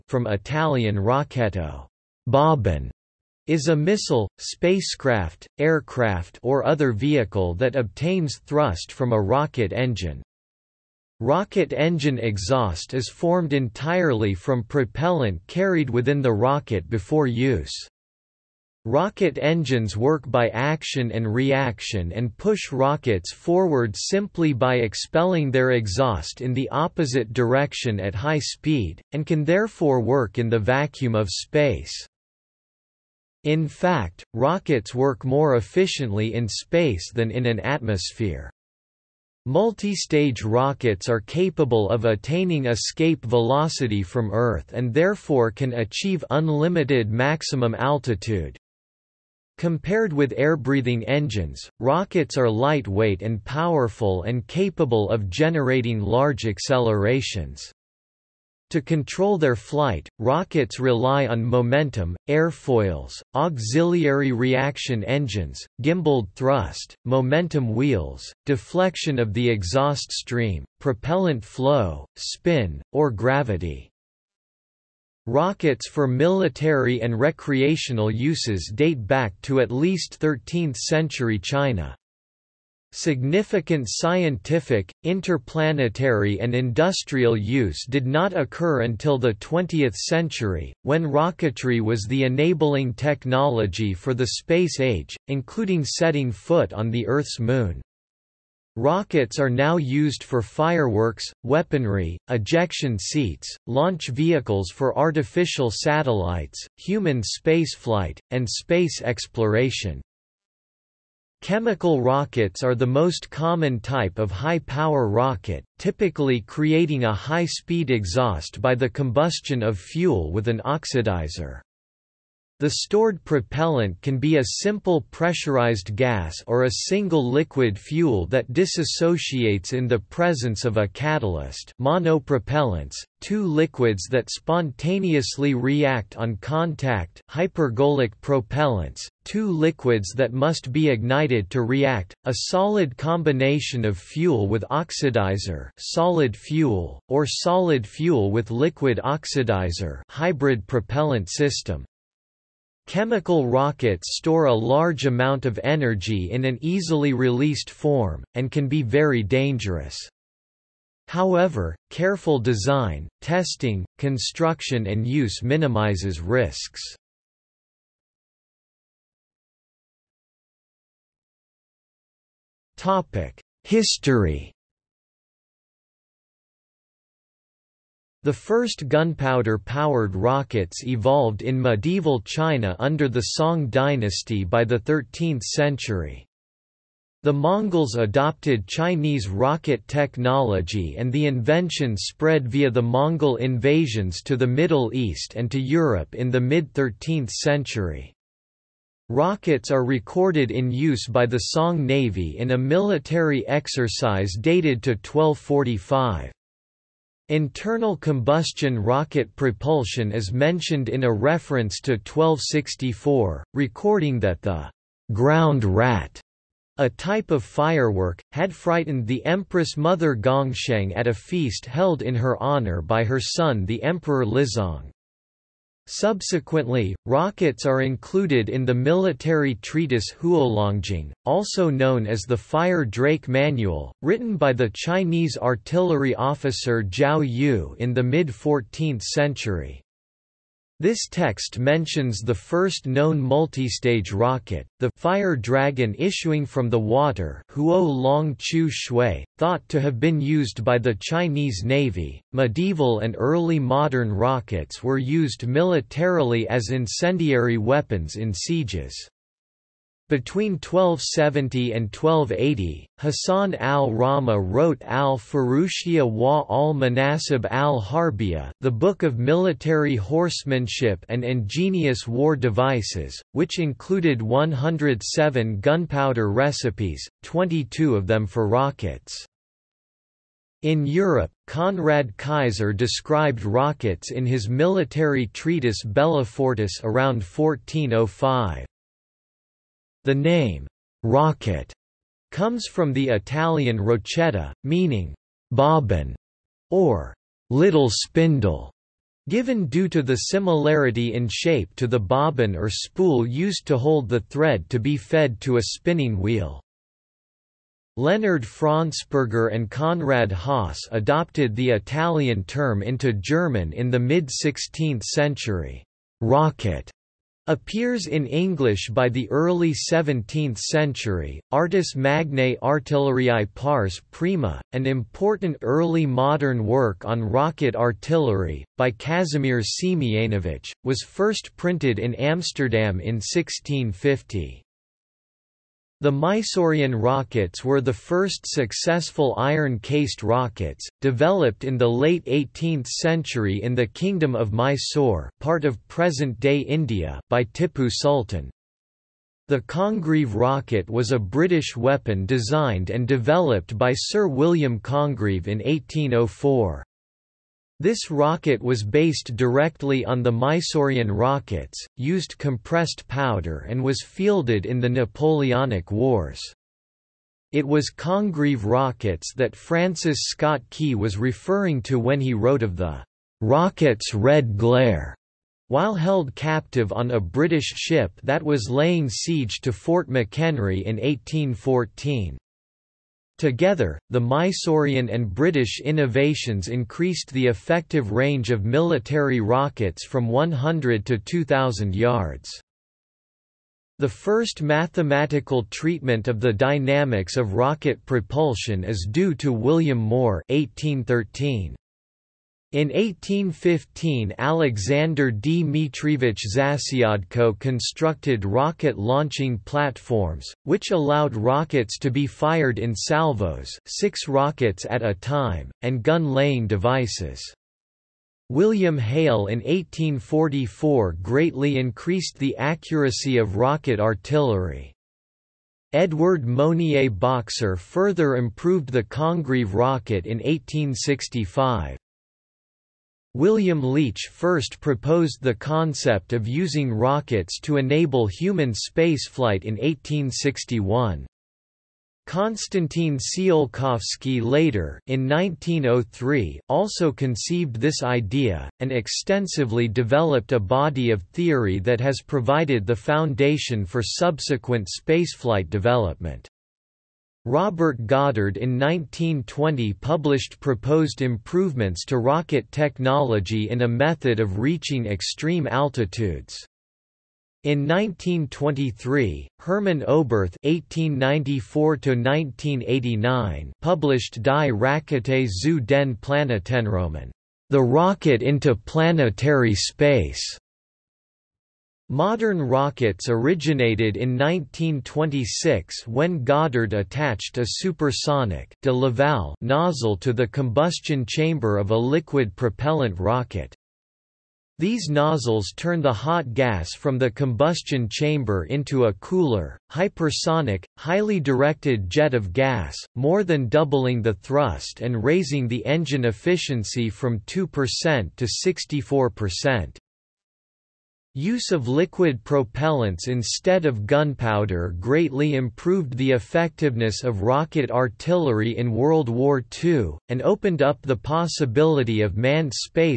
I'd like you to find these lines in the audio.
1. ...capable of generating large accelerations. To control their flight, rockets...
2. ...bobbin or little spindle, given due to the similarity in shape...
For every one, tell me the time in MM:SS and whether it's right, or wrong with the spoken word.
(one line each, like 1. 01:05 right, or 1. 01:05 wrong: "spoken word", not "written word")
1. 00:54 right
2. 04:55 right.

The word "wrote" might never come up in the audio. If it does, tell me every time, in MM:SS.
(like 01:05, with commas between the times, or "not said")
04:24, 06:12.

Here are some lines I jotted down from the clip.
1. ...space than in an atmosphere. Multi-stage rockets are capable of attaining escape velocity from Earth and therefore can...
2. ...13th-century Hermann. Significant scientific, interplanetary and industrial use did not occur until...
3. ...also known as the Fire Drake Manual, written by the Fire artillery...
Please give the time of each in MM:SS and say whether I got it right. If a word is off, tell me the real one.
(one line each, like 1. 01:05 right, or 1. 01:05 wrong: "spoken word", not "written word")
1. 00:36 right
2. 01:20 wrong: "China", not "Hermann"
3. 03:51 wrong: "Chinese", not "Fire".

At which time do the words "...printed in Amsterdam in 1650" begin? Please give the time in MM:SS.
05:31.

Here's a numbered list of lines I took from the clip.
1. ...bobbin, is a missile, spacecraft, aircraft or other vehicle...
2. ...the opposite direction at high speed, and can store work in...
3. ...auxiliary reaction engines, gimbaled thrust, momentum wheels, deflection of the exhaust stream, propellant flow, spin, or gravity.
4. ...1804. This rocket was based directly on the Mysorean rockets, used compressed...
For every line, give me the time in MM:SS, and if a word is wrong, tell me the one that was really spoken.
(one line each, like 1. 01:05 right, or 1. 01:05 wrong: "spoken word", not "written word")
1. 00:02 right
2. 00:26 wrong: "therefore", not "store"
3. 01:03 right
4. 05:55 right.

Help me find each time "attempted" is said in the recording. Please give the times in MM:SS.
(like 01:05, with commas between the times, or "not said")
not said.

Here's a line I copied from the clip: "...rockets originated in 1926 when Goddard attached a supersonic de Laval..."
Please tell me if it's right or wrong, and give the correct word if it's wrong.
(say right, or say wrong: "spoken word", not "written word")
right.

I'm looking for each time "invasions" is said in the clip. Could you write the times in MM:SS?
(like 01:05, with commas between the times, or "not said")
03:13.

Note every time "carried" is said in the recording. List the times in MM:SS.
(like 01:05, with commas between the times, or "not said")
00:15.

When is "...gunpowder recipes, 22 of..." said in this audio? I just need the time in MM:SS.
04:35.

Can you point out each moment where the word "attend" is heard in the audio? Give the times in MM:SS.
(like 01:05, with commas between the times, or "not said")
not said.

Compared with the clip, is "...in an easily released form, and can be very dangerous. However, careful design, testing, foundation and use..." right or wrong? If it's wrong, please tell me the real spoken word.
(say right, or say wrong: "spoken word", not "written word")
wrong: "construction", not "foundation".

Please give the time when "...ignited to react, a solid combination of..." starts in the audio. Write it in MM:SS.
02:20.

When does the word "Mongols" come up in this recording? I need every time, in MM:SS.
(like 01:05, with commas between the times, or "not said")
03:07, 03:12.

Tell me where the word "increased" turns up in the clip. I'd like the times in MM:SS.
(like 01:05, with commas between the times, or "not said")
06:26, 07:01.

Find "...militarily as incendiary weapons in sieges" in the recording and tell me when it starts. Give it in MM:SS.
04:15.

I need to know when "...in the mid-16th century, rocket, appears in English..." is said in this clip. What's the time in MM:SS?
05:13.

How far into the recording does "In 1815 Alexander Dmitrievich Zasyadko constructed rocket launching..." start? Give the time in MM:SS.
06:42.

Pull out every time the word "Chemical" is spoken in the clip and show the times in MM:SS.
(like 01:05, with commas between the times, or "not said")
01:51, 02:32.